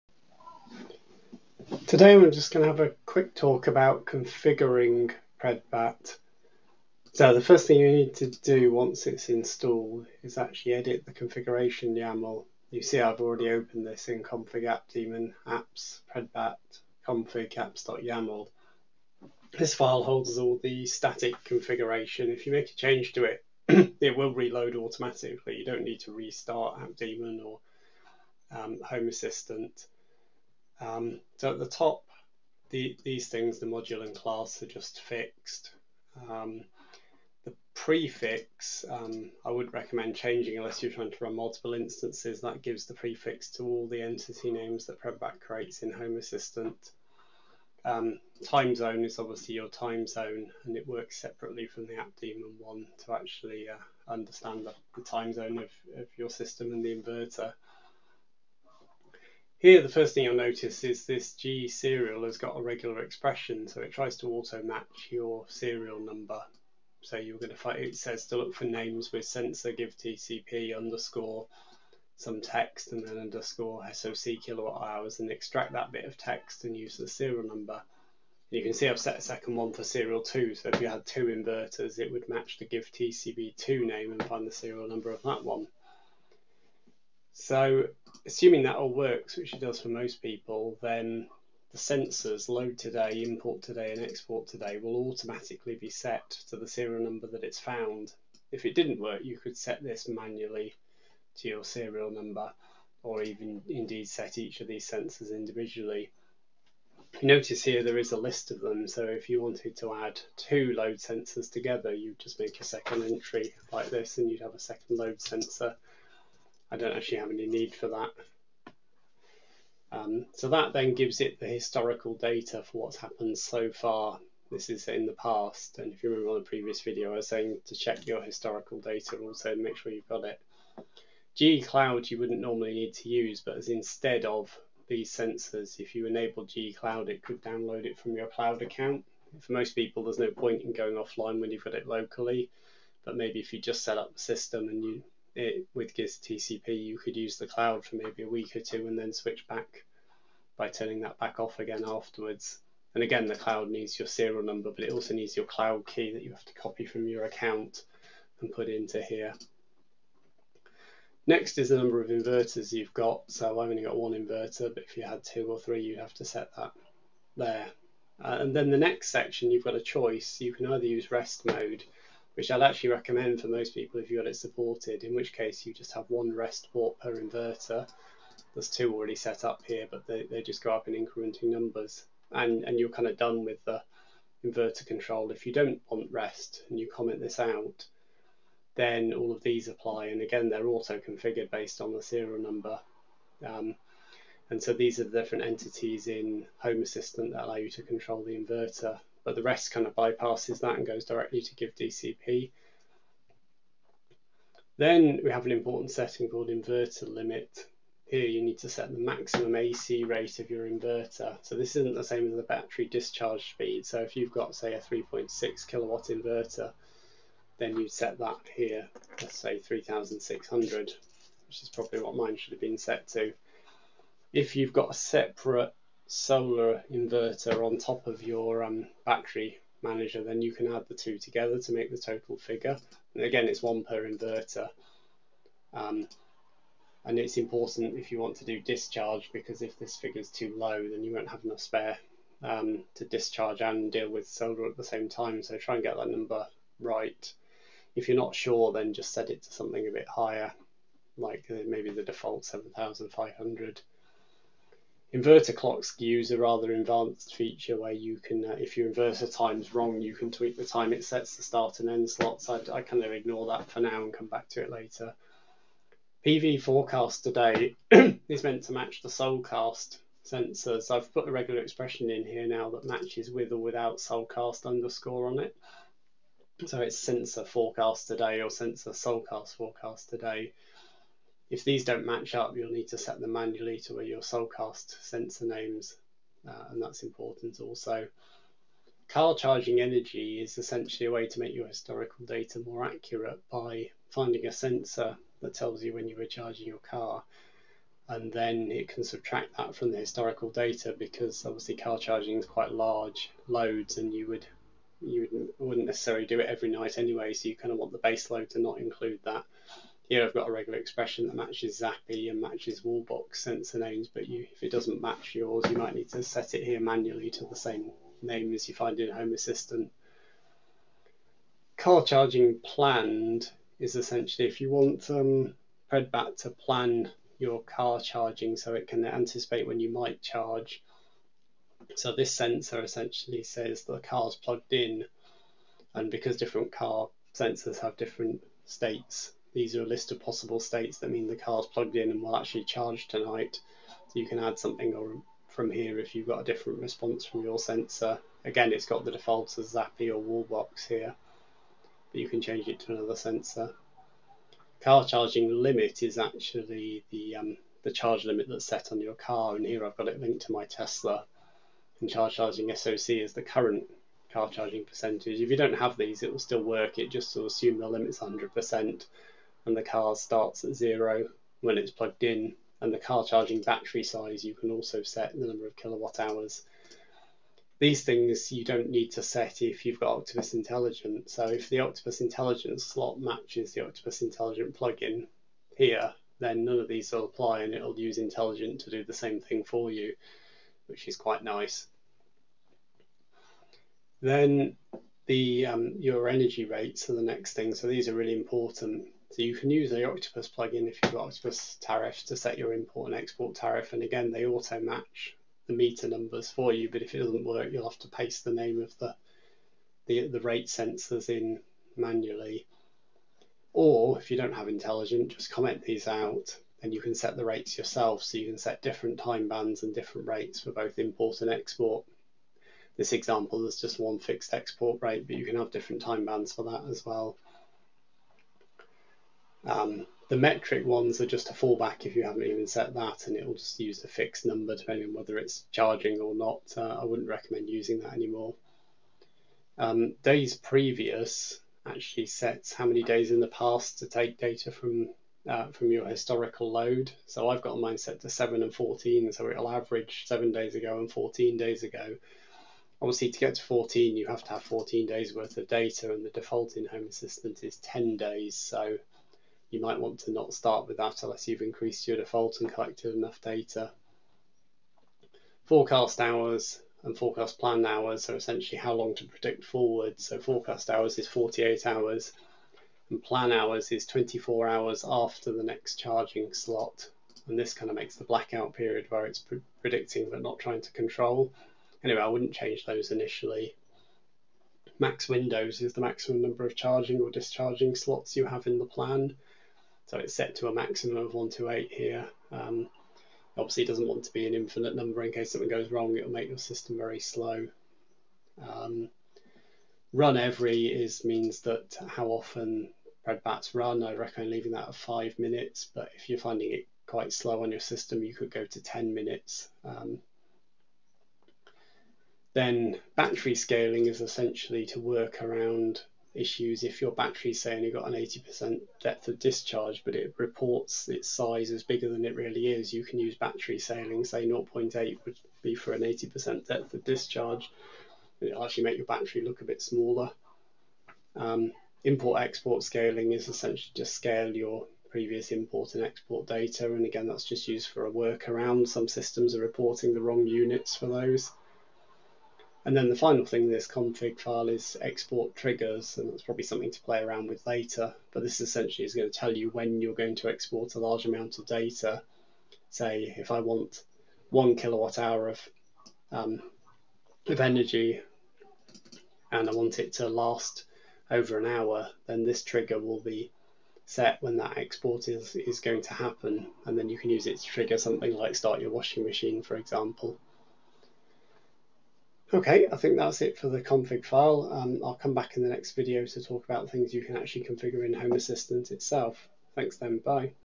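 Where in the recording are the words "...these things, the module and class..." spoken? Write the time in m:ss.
0:33.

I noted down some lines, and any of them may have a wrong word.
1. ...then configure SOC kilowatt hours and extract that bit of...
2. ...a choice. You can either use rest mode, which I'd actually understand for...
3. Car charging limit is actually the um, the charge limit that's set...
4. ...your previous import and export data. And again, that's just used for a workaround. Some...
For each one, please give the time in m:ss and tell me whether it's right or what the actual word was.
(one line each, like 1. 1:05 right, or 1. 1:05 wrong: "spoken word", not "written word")
1. 1:13 wrong: "underscore", not "configure"
2. 2:49 wrong: "recommend", not "understand"
3. 5:54 right
4. 8:54 right.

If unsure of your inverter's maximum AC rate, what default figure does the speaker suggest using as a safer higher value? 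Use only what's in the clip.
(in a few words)
7,500.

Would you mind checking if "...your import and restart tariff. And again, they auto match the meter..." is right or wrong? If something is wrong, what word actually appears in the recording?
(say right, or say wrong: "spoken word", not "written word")
wrong: "export", not "restart".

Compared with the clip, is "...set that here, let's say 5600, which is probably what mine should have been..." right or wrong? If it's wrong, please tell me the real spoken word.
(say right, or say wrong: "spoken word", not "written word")
wrong: "3600", not "5600".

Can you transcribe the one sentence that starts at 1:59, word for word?
Um, so that then gives it the historical data for what's happened so far.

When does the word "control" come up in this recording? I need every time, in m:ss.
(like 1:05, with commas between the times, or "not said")
3:04, 3:17, 8:00.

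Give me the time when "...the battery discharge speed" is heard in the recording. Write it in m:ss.
3:32.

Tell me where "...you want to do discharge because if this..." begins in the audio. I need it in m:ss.
3:58.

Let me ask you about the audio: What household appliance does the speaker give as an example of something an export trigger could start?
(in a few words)
washing machine.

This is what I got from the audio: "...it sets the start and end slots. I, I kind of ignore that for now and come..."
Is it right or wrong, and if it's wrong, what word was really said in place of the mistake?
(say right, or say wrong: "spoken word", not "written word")
right.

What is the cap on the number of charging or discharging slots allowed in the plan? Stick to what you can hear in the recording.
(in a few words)
128.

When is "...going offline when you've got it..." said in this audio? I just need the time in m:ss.
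2:20.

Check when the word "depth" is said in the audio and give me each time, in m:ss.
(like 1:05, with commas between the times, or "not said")
8:39, 8:46.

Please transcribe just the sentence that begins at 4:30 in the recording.
I've put a regular expression in here now that matches with or without Solcast underscore on it.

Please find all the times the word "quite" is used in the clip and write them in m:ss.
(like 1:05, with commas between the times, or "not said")
5:02, 6:31, 8:27.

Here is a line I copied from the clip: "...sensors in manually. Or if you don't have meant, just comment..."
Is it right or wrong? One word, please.
wrong.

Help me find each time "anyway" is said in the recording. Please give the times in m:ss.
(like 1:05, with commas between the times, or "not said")
5:06, 8:02.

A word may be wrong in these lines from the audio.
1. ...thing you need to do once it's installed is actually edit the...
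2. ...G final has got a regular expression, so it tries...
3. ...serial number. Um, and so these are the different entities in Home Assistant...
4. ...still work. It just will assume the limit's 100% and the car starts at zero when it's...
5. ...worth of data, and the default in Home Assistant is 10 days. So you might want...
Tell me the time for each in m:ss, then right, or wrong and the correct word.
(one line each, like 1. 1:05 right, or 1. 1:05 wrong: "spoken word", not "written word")
1. 0:07 right
2. 1:01 wrong: "serial", not "final"
3. 3:12 right
4. 6:06 right
5. 7:35 right.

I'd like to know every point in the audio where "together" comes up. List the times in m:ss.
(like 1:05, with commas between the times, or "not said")
1:51, 3:51.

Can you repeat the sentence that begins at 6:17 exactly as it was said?
These things you don't need to set if you've got Octopus Intelligent.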